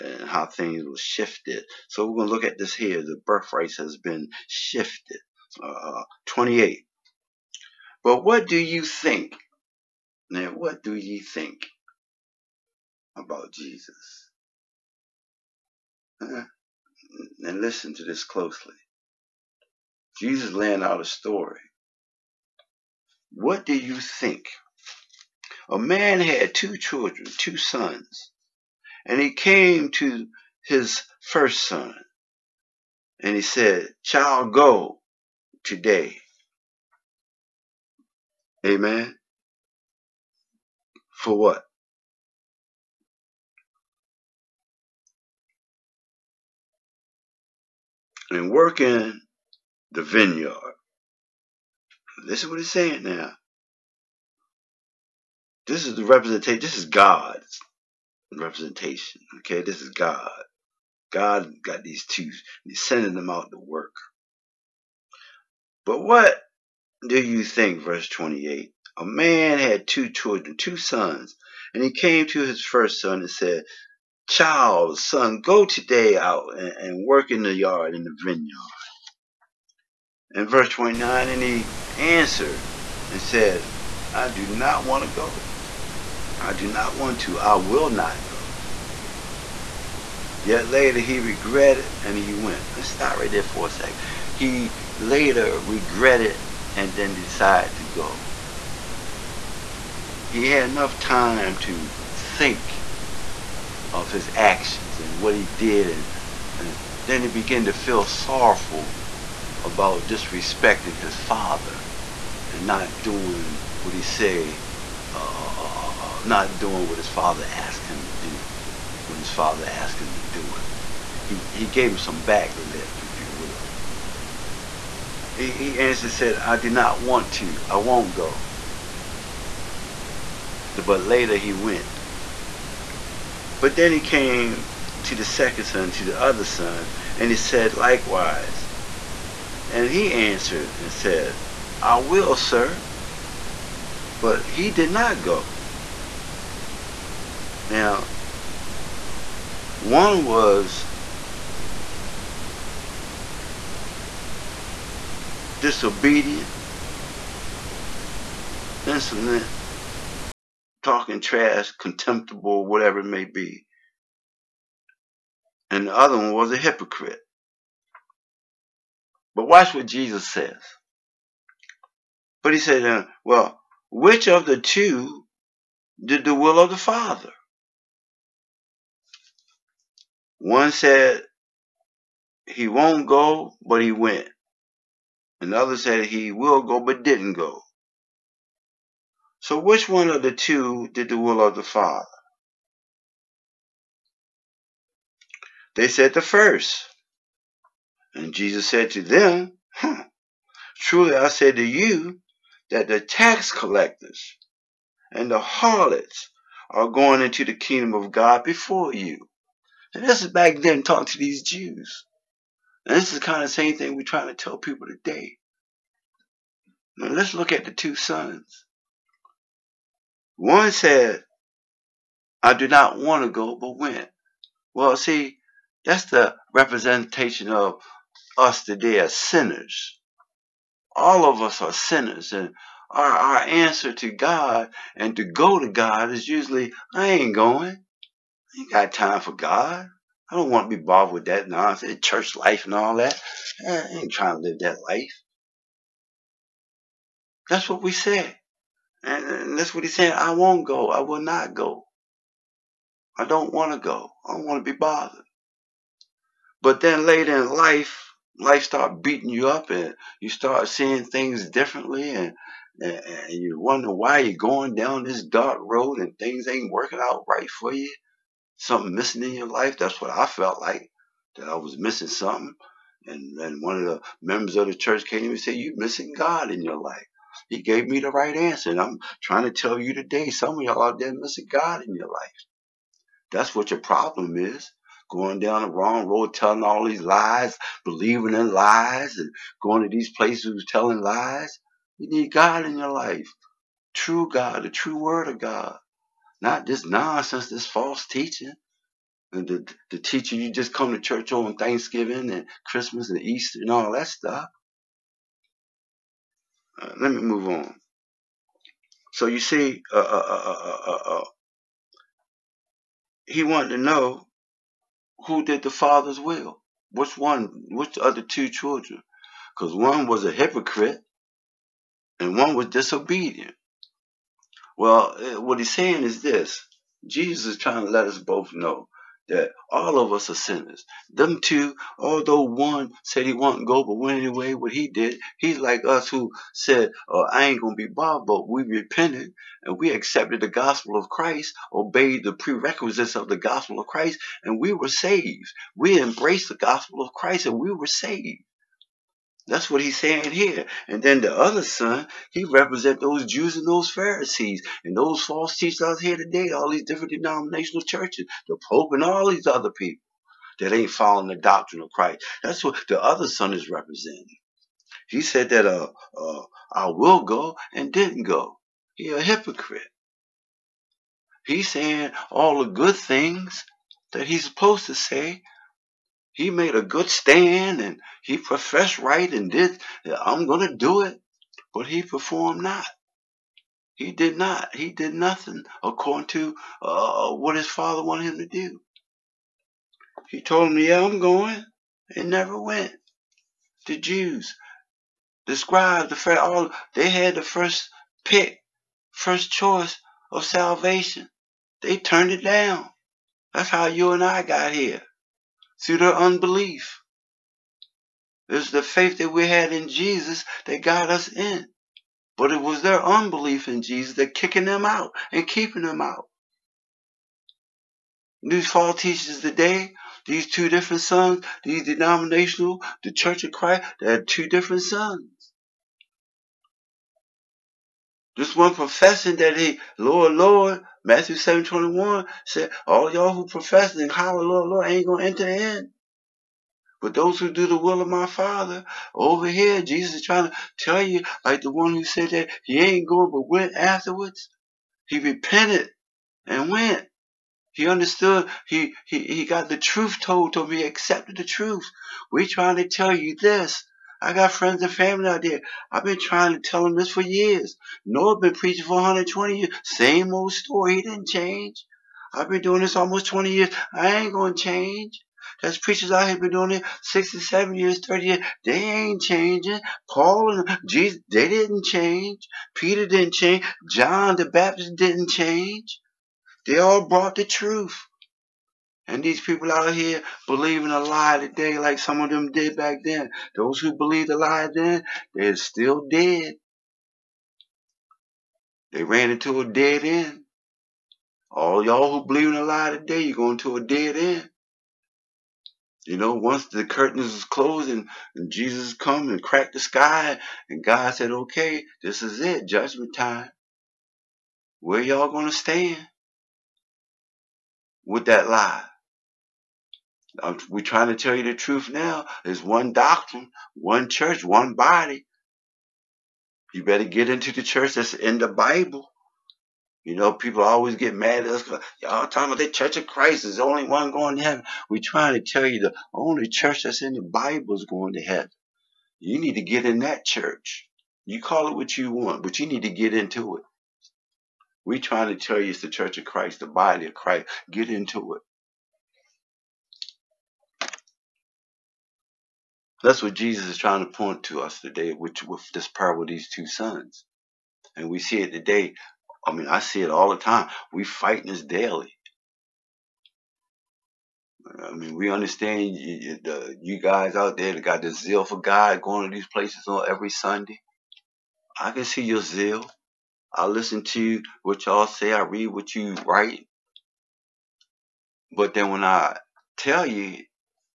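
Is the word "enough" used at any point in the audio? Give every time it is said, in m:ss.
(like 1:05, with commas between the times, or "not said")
1:40.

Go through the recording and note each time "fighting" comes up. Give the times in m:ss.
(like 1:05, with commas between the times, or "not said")
9:11.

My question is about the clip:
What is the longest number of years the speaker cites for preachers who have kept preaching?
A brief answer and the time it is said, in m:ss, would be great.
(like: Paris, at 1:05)
67, at 7:47.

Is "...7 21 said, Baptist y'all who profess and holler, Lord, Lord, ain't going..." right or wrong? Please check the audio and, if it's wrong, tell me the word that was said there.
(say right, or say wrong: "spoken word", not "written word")
wrong: "All", not "Baptist".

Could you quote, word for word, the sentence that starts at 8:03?
Those who believed a lie then, they're still dead.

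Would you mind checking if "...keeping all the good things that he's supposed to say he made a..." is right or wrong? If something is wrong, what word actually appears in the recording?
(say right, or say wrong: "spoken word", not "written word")
wrong: "saying", not "keeping".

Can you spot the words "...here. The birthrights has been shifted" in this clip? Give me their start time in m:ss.
0:02.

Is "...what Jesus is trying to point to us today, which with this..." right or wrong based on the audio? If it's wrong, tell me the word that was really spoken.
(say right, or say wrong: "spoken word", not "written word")
right.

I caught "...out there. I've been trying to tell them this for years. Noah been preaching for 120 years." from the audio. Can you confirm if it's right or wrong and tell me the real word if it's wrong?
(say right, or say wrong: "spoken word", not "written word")
right.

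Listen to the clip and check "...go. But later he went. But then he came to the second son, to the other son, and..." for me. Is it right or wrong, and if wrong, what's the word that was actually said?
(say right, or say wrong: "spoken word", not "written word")
right.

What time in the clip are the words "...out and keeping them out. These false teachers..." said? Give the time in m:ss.
6:54.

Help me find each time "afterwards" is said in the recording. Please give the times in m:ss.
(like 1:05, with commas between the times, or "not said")
7:23.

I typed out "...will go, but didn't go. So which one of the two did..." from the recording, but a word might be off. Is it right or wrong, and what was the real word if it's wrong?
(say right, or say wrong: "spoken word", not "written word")
right.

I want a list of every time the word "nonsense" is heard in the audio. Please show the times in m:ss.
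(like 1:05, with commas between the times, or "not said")
4:01, 4:56.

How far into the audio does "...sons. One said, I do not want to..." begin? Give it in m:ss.
3:37.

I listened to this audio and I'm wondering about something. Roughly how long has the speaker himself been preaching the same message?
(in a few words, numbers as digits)
Almost 20 years.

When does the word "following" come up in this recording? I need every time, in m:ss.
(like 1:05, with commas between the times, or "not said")
6:00.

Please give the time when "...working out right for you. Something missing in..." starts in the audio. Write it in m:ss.
4:26.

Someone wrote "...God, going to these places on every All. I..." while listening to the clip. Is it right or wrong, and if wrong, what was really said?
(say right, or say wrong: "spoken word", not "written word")
wrong: "Sunday", not "All".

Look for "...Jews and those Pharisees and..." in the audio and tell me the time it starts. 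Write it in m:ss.
5:53.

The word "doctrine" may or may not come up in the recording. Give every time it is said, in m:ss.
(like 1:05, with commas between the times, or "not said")
6:01, 8:32.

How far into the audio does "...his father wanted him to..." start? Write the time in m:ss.
6:27.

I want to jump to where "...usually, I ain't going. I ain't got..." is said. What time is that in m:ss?
3:56.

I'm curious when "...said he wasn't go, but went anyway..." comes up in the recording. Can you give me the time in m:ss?
5:33.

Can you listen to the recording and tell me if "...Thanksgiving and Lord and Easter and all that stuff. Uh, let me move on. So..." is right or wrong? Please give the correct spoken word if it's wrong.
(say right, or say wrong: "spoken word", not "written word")
wrong: "Christmas", not "Lord".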